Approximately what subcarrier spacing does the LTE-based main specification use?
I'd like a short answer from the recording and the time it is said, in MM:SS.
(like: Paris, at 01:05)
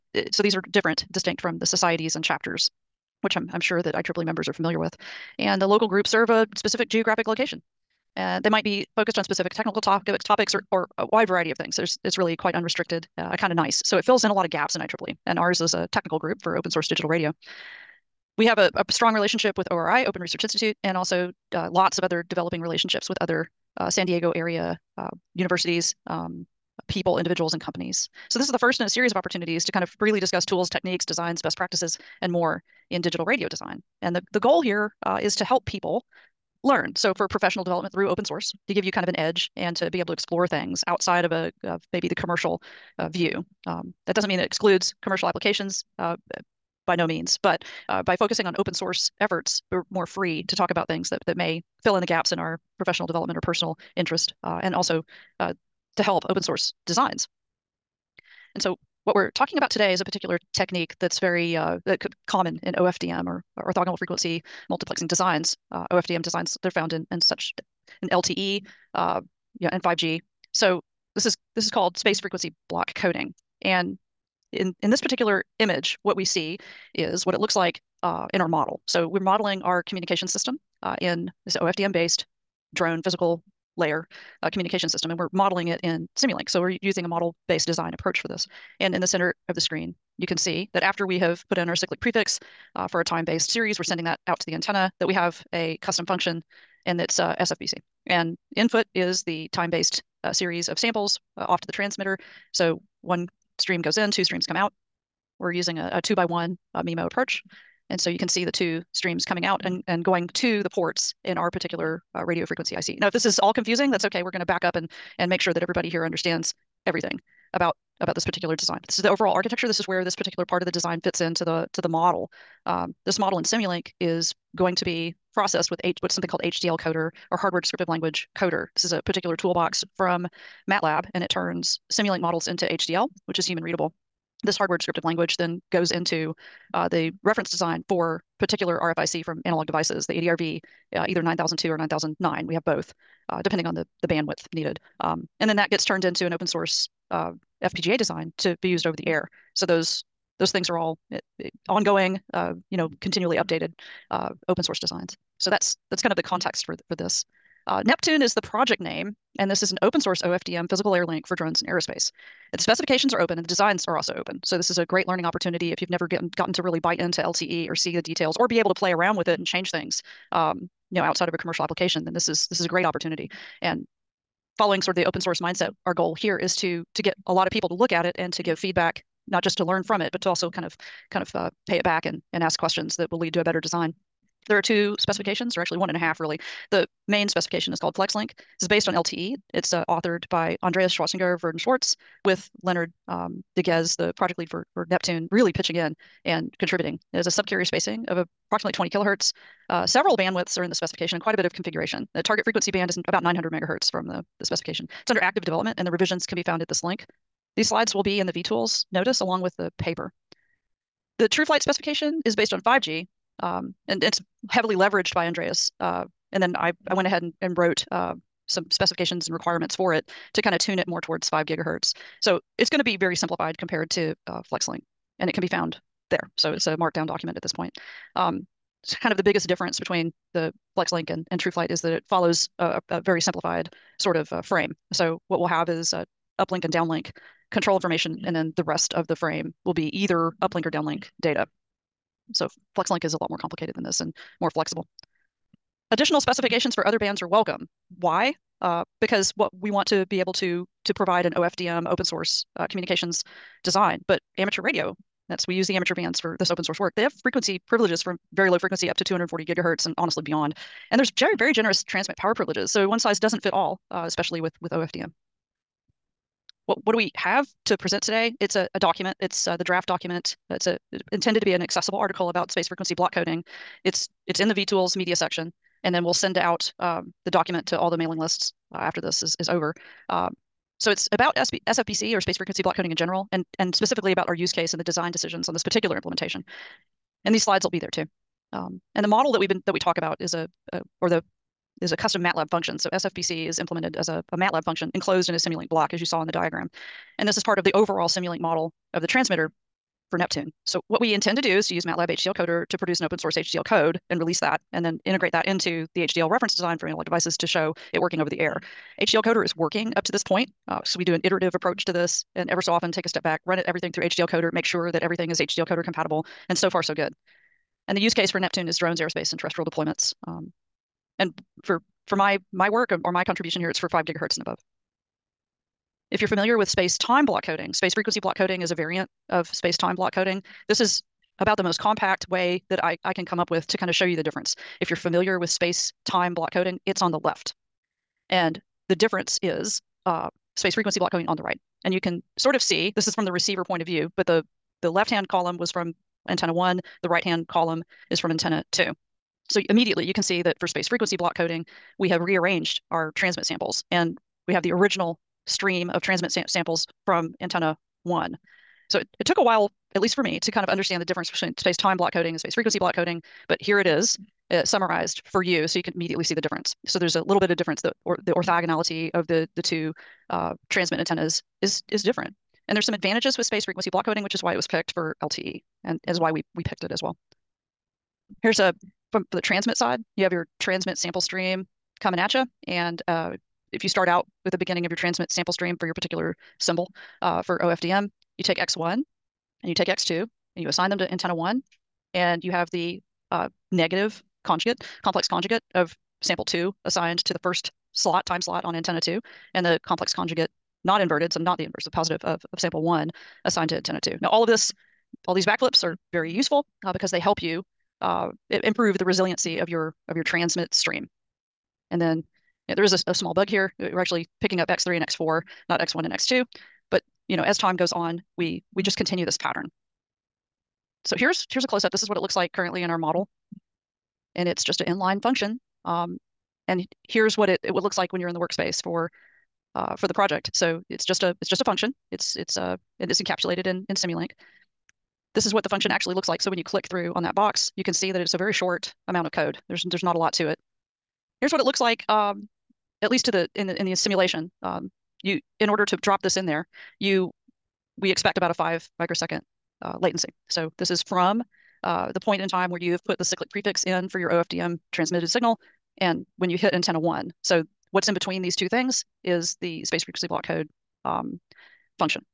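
20 kilohertz, at 03:18.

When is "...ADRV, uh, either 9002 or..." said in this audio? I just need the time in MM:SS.
02:20.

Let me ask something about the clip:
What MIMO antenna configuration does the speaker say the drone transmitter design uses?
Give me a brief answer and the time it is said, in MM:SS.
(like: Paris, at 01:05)
2 by 1, at 01:46.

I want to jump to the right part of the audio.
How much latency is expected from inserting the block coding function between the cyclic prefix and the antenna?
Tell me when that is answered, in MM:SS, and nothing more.
07:28.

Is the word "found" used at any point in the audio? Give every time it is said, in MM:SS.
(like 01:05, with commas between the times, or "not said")
01:06, 03:26, 03:45.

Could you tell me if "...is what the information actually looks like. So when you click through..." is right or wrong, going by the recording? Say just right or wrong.
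wrong.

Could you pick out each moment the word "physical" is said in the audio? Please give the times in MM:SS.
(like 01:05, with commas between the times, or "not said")
01:23, 02:40.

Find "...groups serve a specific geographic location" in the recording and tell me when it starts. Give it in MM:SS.
00:05.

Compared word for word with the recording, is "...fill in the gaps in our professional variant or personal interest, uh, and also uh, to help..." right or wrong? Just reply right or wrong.
wrong.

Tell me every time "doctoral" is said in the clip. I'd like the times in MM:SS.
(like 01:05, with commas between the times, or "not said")
not said.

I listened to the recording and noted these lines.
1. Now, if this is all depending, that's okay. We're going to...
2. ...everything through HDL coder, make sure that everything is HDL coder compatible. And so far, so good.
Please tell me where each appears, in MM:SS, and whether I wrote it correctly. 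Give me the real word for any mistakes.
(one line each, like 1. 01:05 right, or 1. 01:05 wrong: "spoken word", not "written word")
1. 01:52 wrong: "confusing", not "depending"
2. 05:13 right.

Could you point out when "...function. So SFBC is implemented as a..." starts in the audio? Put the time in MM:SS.
04:52.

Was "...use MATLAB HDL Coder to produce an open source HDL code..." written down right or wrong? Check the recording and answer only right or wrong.
right.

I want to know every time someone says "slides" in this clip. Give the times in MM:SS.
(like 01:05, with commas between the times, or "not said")
03:27, 04:47.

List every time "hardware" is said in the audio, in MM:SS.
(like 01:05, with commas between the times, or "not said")
02:07, 02:14.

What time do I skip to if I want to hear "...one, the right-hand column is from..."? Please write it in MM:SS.
05:46.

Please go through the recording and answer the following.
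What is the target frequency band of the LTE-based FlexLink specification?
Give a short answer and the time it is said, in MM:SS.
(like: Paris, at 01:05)
900 megahertz, at 03:23.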